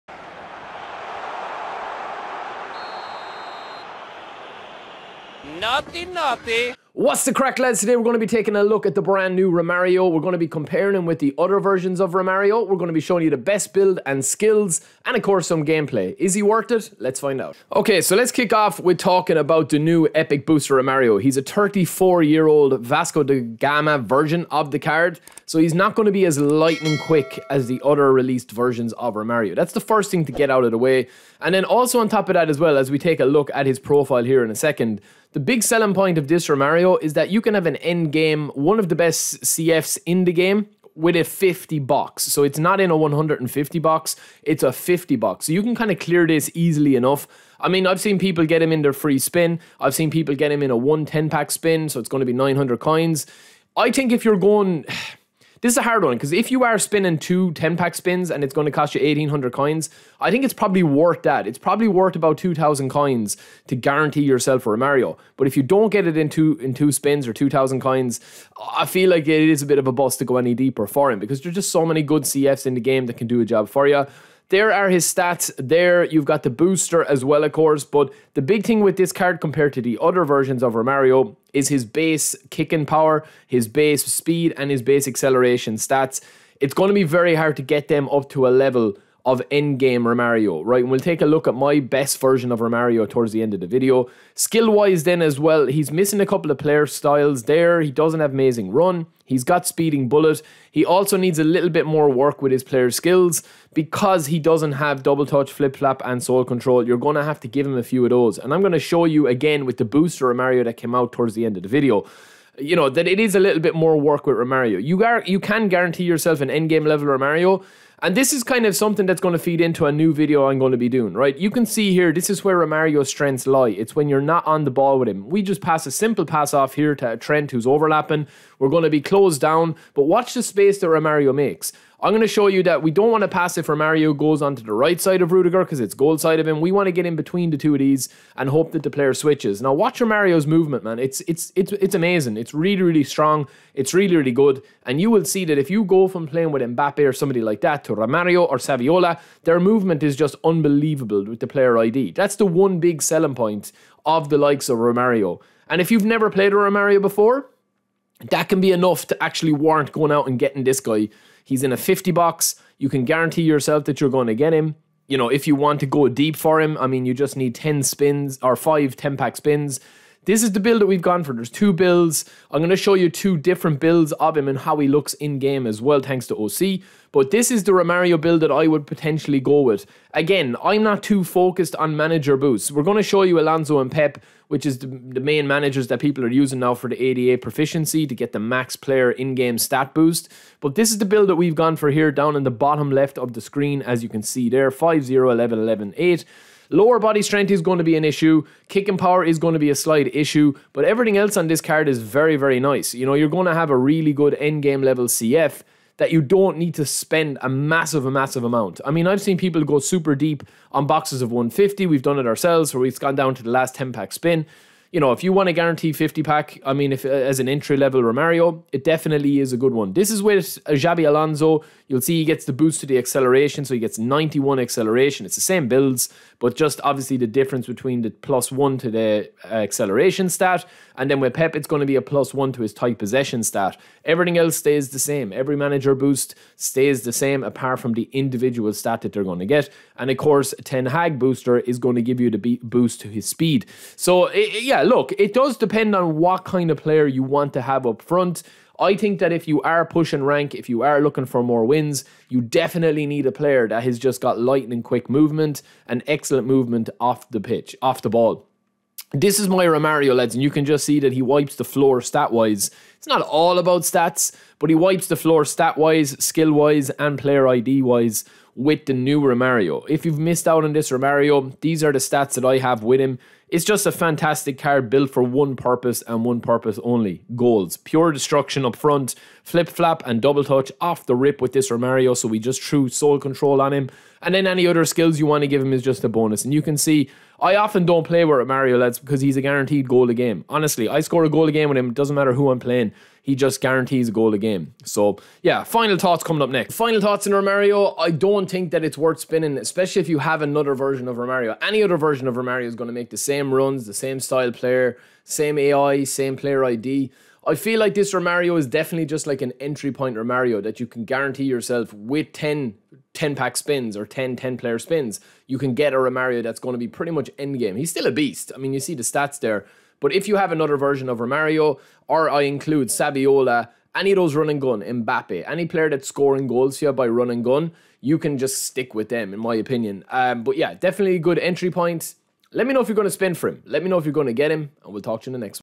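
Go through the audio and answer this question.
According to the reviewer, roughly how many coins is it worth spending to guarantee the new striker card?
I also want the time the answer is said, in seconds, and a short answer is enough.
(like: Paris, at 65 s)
2000 coins, at 62 s.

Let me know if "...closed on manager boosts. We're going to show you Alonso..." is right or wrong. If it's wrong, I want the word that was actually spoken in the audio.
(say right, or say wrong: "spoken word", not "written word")
wrong: "focused", not "closed".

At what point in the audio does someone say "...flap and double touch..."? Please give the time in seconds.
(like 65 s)
279 s.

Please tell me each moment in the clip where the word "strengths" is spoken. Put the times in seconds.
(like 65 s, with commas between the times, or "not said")
123 s, 197 s.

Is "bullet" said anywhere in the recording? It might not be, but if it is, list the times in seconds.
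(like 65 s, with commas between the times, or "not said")
100 s.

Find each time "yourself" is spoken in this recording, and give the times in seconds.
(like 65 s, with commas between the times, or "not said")
64 s, 116 s, 163 s, 311 s.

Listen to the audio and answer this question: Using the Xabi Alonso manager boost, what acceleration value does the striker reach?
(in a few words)
91.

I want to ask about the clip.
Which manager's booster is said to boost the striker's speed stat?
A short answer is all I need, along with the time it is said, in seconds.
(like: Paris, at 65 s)
Ten Hag, at 240 s.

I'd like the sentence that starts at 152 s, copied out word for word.
That's the one big selling point of the likes of Romario.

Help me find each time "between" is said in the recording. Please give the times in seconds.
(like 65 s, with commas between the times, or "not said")
137 s, 227 s.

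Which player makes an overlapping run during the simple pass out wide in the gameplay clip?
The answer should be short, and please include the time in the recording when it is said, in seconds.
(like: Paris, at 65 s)
Trent, at 127 s.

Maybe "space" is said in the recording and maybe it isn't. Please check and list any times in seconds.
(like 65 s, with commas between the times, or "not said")
130 s.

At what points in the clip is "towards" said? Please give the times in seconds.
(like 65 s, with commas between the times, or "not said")
93 s, 111 s.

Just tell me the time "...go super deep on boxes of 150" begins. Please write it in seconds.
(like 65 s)
209 s.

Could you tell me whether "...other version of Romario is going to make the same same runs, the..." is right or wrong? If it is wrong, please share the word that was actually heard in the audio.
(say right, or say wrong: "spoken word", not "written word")
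right.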